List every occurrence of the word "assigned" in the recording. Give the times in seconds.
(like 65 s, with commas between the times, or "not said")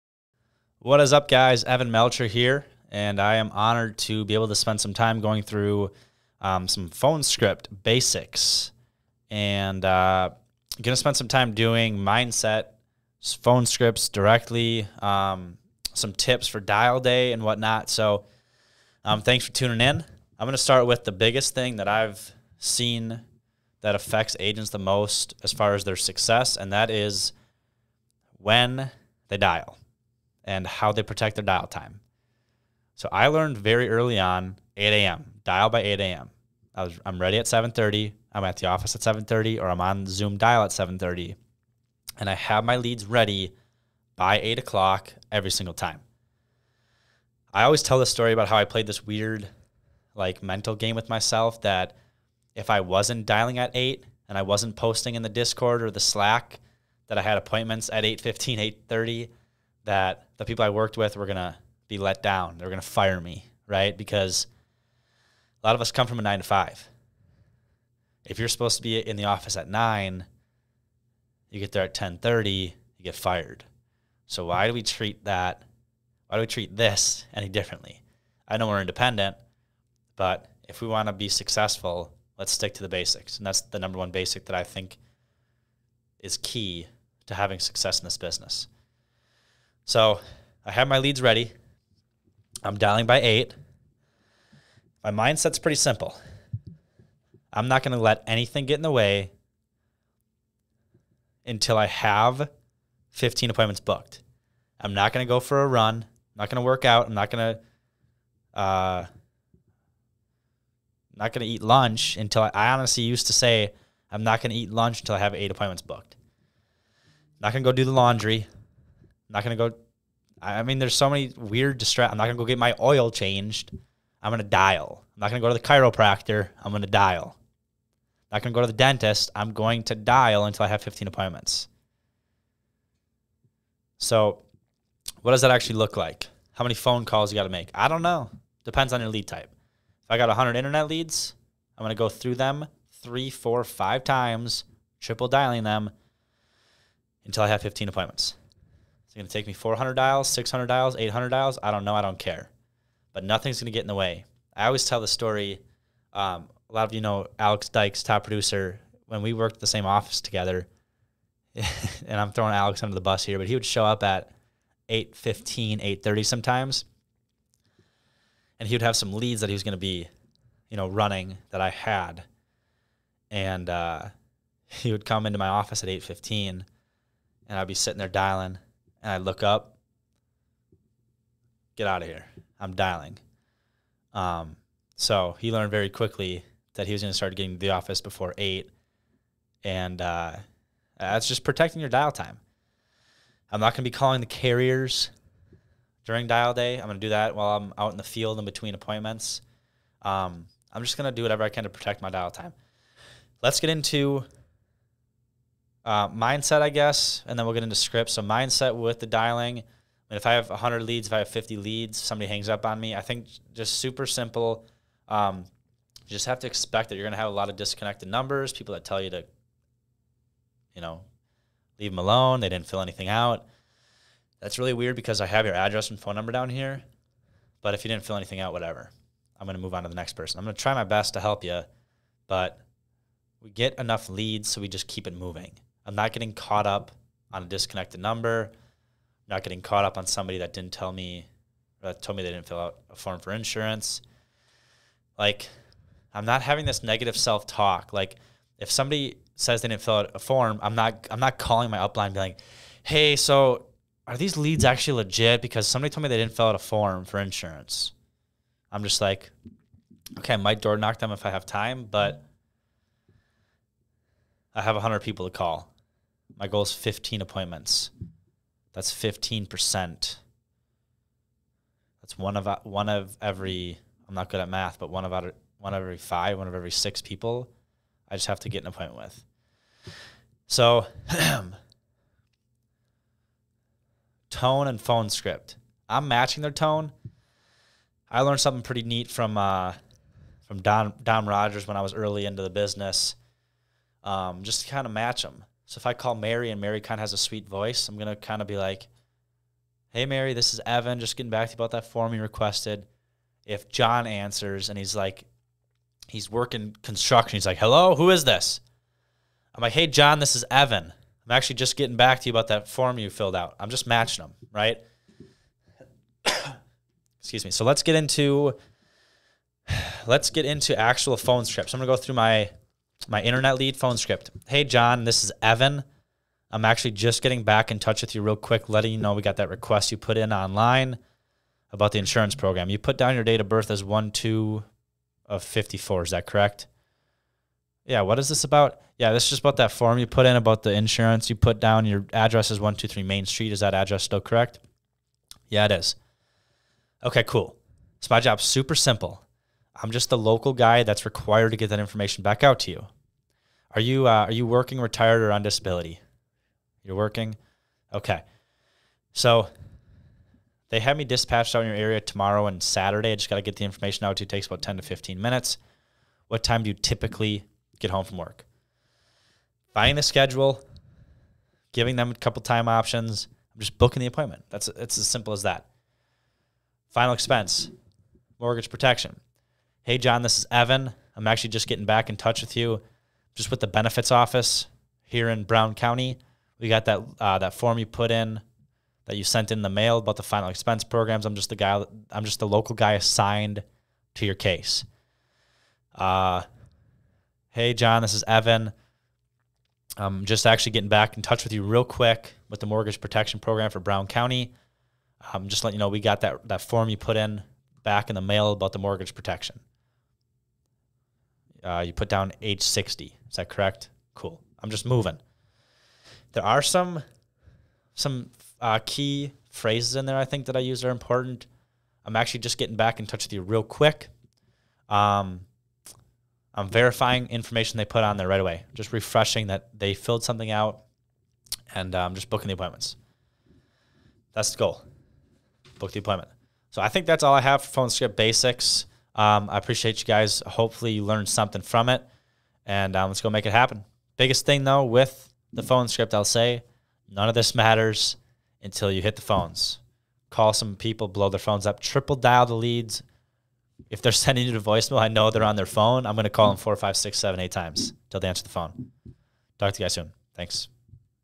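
392 s.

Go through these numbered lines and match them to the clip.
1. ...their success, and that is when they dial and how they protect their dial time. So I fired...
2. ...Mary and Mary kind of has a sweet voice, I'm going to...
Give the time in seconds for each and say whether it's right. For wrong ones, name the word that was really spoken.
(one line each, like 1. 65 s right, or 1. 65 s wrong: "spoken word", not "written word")
1. 25 s wrong: "learned", not "fired"
2. 296 s right.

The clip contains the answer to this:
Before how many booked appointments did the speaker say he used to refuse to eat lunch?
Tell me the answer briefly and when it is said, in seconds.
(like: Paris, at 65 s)
8, at 115 s.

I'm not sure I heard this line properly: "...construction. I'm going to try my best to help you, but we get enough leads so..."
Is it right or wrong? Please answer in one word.
wrong.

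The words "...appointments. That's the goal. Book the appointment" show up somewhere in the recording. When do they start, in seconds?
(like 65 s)
432 s.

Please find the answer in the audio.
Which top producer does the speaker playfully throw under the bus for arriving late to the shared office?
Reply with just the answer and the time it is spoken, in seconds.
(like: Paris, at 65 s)
Alex Dykes, at 157 s.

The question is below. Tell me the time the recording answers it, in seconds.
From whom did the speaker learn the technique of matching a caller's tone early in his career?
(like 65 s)
291 s.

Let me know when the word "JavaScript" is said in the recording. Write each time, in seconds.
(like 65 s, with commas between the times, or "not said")
not said.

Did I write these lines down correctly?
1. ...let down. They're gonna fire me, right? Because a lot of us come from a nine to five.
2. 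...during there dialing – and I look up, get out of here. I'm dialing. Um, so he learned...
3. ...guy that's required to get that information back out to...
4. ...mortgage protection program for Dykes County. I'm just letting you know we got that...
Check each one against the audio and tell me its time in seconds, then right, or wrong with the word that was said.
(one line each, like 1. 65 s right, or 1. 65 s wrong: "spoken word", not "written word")
1. 61 s right
2. 177 s wrong: "sitting", not "during"
3. 350 s right
4. 402 s wrong: "Brown", not "Dykes".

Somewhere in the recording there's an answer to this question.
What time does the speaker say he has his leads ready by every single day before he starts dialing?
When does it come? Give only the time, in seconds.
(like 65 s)
44 s.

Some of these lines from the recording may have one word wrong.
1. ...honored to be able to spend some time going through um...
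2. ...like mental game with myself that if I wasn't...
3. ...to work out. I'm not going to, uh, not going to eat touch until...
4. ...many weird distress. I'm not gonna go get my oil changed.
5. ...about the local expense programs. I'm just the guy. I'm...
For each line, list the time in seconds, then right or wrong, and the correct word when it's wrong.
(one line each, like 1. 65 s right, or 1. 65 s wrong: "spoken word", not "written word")
1. 3 s right
2. 50 s right
3. 106 s wrong: "lunch", not "touch"
4. 121 s right
5. 389 s wrong: "final", not "local".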